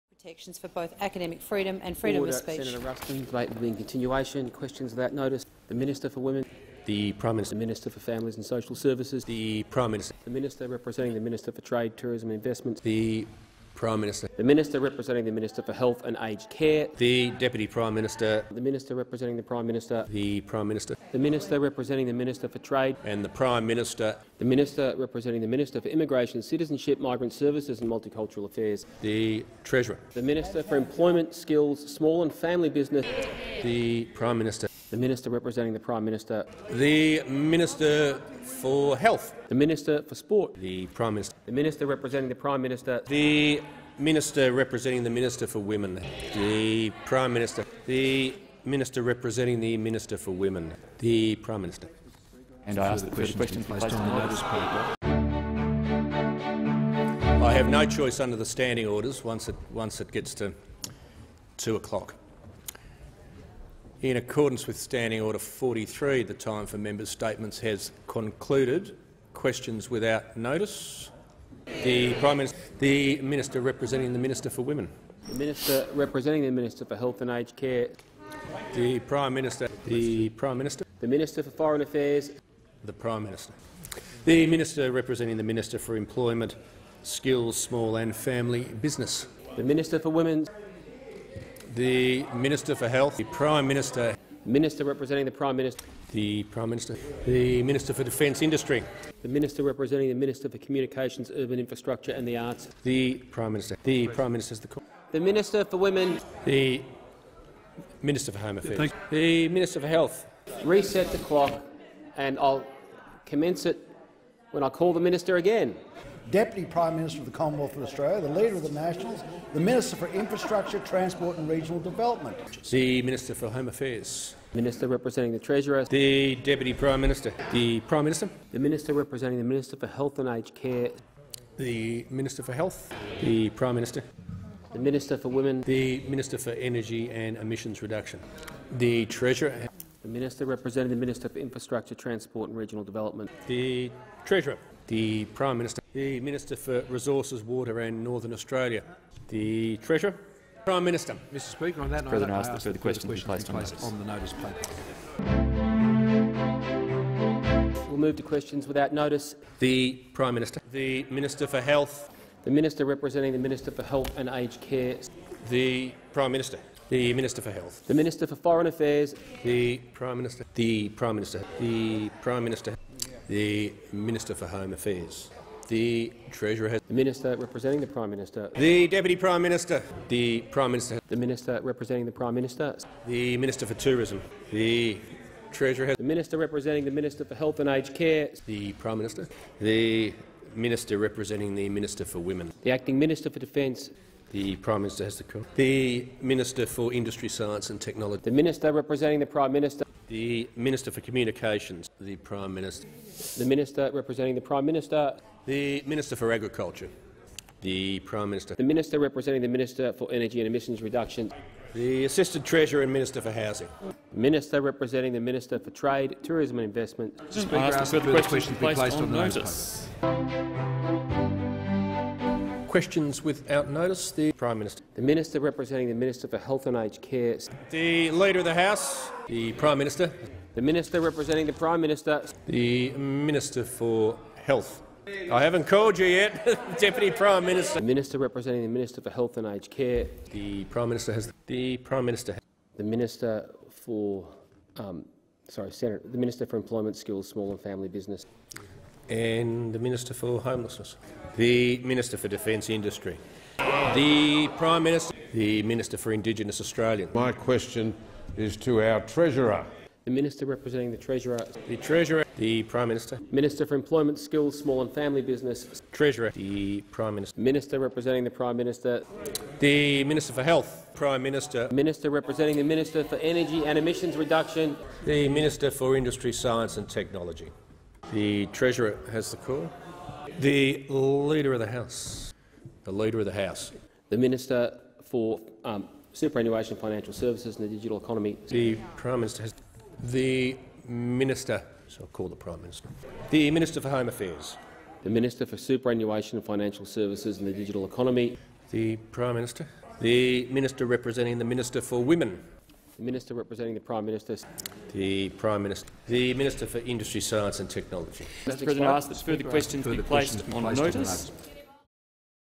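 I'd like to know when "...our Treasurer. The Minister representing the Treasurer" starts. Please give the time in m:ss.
4:18.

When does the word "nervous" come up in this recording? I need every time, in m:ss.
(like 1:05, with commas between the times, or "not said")
not said.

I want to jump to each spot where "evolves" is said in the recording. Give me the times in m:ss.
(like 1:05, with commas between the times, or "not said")
not said.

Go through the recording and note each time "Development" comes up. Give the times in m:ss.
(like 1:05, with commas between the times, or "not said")
2:01, 2:22.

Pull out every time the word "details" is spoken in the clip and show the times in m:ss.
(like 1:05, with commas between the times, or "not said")
not said.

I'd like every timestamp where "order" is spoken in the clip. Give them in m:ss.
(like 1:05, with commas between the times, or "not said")
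0:02, 0:58, 1:05.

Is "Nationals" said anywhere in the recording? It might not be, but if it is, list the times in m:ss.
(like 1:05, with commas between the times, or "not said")
1:58.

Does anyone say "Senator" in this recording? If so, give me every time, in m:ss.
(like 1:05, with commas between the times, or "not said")
0:02, 4:05.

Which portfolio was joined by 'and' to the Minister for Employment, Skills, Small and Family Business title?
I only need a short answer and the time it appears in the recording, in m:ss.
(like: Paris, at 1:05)
Homelessness, at 4:09.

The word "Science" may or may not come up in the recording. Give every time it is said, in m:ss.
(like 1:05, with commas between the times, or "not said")
3:17, 4:36, 5:07.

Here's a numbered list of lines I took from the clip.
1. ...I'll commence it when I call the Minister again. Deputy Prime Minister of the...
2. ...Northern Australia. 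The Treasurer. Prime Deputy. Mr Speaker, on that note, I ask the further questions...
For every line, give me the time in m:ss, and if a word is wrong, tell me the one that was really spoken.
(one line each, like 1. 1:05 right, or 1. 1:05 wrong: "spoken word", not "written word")
1. 1:52 right
2. 2:28 wrong: "Minister", not "Deputy".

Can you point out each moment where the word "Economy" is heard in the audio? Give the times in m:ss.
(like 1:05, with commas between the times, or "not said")
4:47, 4:57.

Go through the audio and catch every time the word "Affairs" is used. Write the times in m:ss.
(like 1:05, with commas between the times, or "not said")
0:28, 1:21, 1:48, 2:03, 2:48, 2:54, 4:54.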